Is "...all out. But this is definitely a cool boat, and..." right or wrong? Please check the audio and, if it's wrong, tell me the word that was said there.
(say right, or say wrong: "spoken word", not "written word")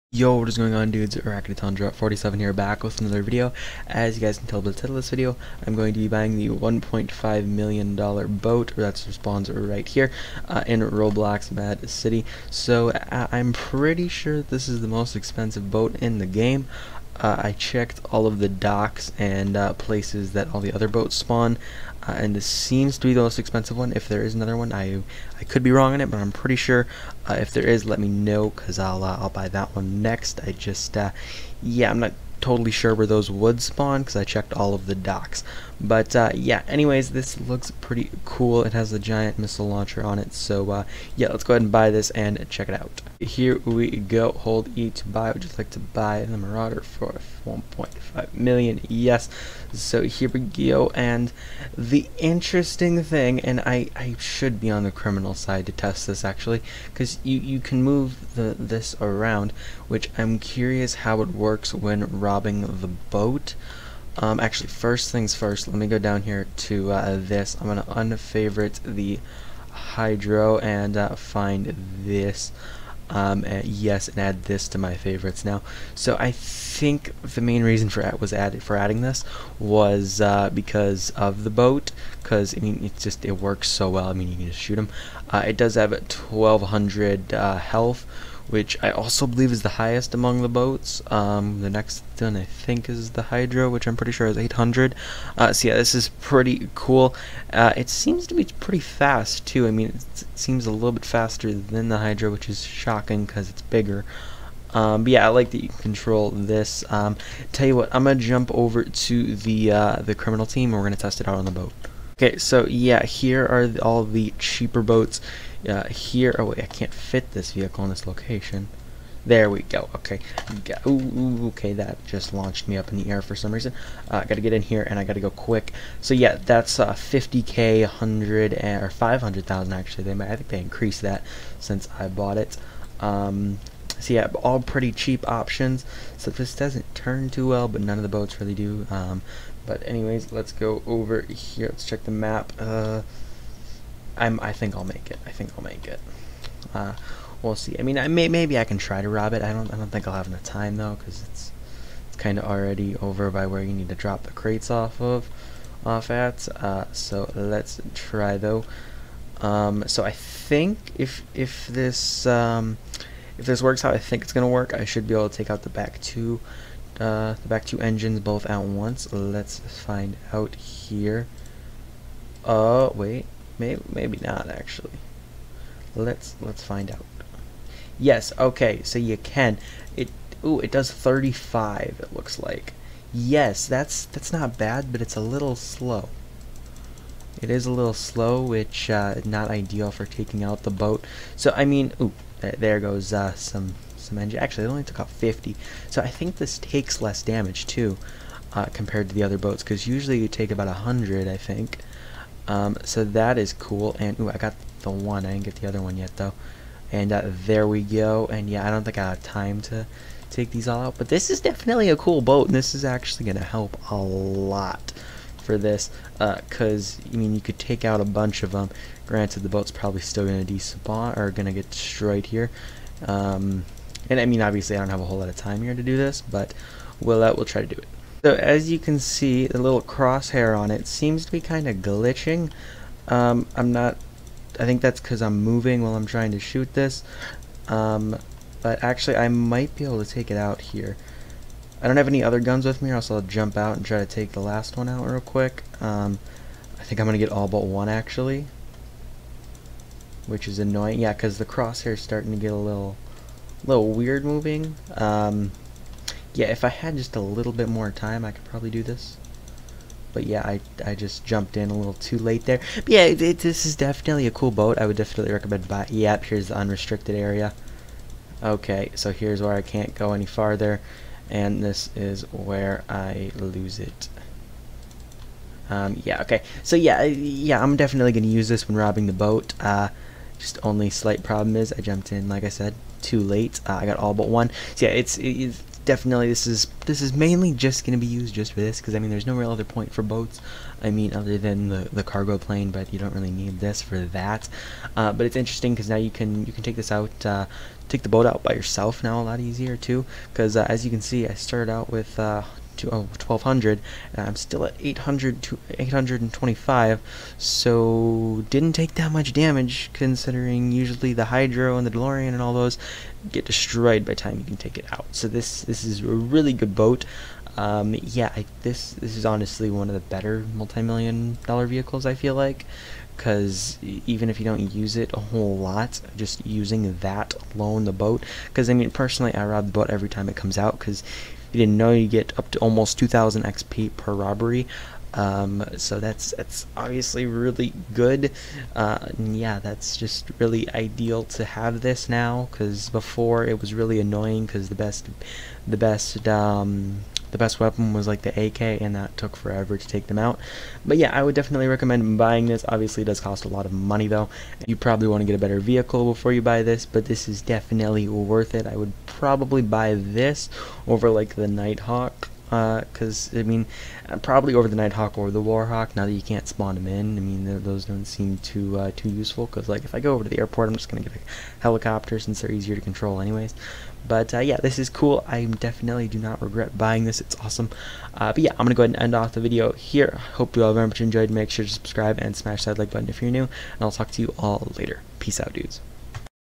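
right.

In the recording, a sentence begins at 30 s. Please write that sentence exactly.
I just uh, yeah, I'm not totally sure where those would spawn, cause I checked all of the docks.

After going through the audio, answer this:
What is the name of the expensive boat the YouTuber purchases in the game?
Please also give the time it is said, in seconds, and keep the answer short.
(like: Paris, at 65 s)
Marauder, at 46 s.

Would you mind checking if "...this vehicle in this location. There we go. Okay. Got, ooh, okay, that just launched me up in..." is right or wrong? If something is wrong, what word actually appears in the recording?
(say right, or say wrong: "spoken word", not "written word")
right.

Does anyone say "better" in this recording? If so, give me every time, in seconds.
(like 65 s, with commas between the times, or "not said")
319 s, 355 s.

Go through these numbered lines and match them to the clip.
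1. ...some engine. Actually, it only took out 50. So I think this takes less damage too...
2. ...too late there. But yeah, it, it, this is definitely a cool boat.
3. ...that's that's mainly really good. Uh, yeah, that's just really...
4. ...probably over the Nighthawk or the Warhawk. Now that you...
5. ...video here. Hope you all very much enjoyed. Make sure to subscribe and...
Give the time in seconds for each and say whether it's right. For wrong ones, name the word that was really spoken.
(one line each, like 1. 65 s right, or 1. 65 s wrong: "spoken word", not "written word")
1. 193 s right
2. 261 s right
3. 335 s wrong: "obviously", not "mainly"
4. 364 s right
5. 379 s right.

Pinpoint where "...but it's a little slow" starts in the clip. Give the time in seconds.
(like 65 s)
184 s.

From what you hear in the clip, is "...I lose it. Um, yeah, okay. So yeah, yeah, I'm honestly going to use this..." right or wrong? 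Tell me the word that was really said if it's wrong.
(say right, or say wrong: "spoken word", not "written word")
wrong: "definitely", not "honestly".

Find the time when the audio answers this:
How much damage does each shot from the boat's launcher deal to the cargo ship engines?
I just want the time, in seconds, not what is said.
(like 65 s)
180 s.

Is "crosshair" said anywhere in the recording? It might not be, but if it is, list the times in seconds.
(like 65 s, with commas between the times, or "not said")
229 s, 251 s.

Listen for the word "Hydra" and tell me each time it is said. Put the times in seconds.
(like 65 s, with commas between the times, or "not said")
69 s, 93 s, 101 s, 311 s.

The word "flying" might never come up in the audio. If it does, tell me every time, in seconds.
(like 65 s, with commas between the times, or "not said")
not said.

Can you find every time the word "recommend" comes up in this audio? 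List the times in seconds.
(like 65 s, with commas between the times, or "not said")
265 s, 351 s.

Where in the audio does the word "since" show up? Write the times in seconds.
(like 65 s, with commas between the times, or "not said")
131 s, 372 s.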